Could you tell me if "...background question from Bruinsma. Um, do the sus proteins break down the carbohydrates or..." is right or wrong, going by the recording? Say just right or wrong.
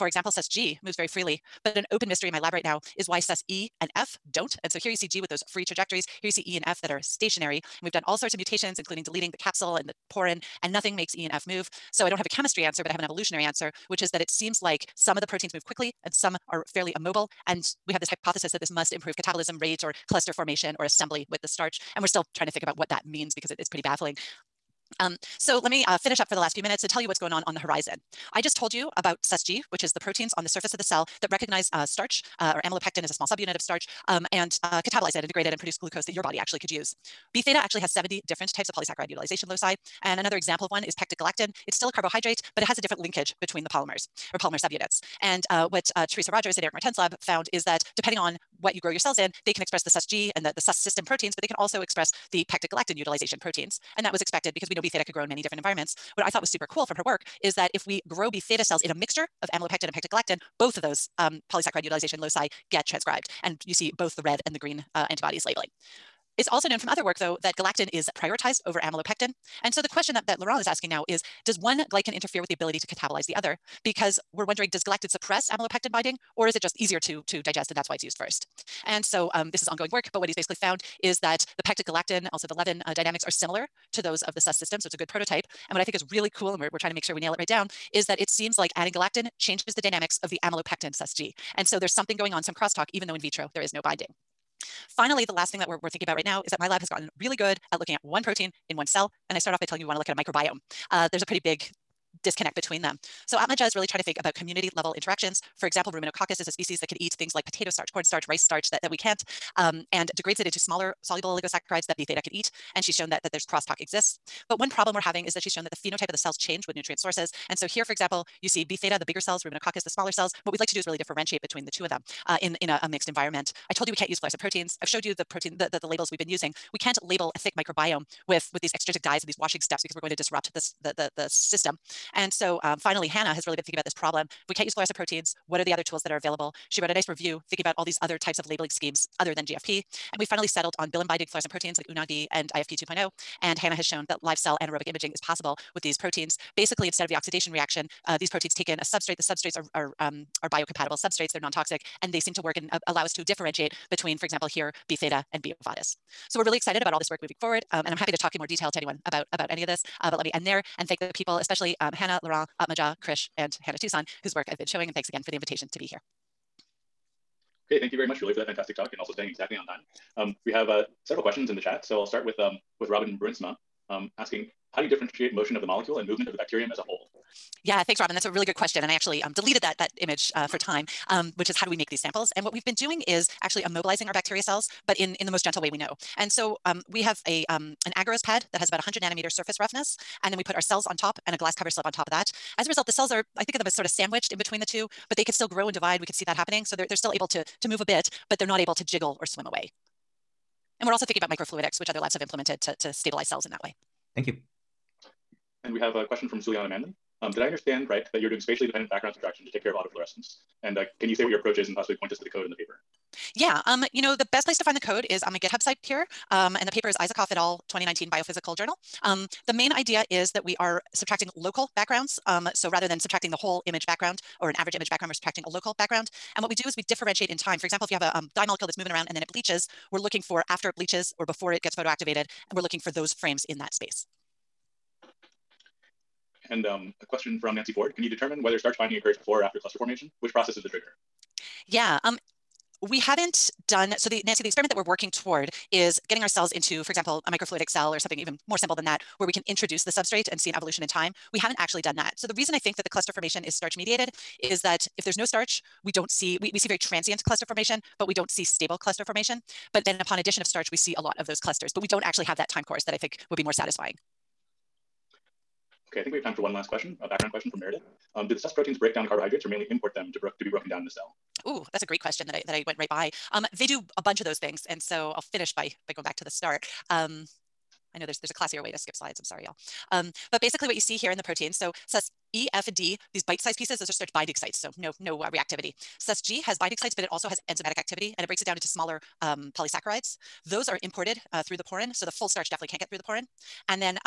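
wrong.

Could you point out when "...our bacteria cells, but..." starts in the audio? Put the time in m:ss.
3:04.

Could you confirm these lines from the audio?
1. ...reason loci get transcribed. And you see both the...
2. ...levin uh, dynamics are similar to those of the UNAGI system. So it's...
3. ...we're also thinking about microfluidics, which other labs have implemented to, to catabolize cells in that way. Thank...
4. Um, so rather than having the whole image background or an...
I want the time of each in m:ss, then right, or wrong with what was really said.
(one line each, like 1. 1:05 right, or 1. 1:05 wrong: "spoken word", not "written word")
1. 1:01 wrong: "utilization", not "reason"
2. 1:22 wrong: "SUS", not "UNAGI"
3. 3:20 wrong: "stabilize", not "catabolize"
4. 3:42 wrong: "subtracting", not "having".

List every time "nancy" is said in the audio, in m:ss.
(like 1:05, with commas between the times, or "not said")
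3:57, 4:04.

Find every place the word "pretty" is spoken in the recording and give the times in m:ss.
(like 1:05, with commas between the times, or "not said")
0:23, 1:41.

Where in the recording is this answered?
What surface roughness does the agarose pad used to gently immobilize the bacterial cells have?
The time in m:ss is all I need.
3:08.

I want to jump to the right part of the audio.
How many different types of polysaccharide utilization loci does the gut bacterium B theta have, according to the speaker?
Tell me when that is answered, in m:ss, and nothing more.
0:37.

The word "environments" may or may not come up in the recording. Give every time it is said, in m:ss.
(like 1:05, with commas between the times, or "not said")
0:55, 2:03.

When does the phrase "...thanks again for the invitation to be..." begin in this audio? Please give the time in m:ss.
2:44.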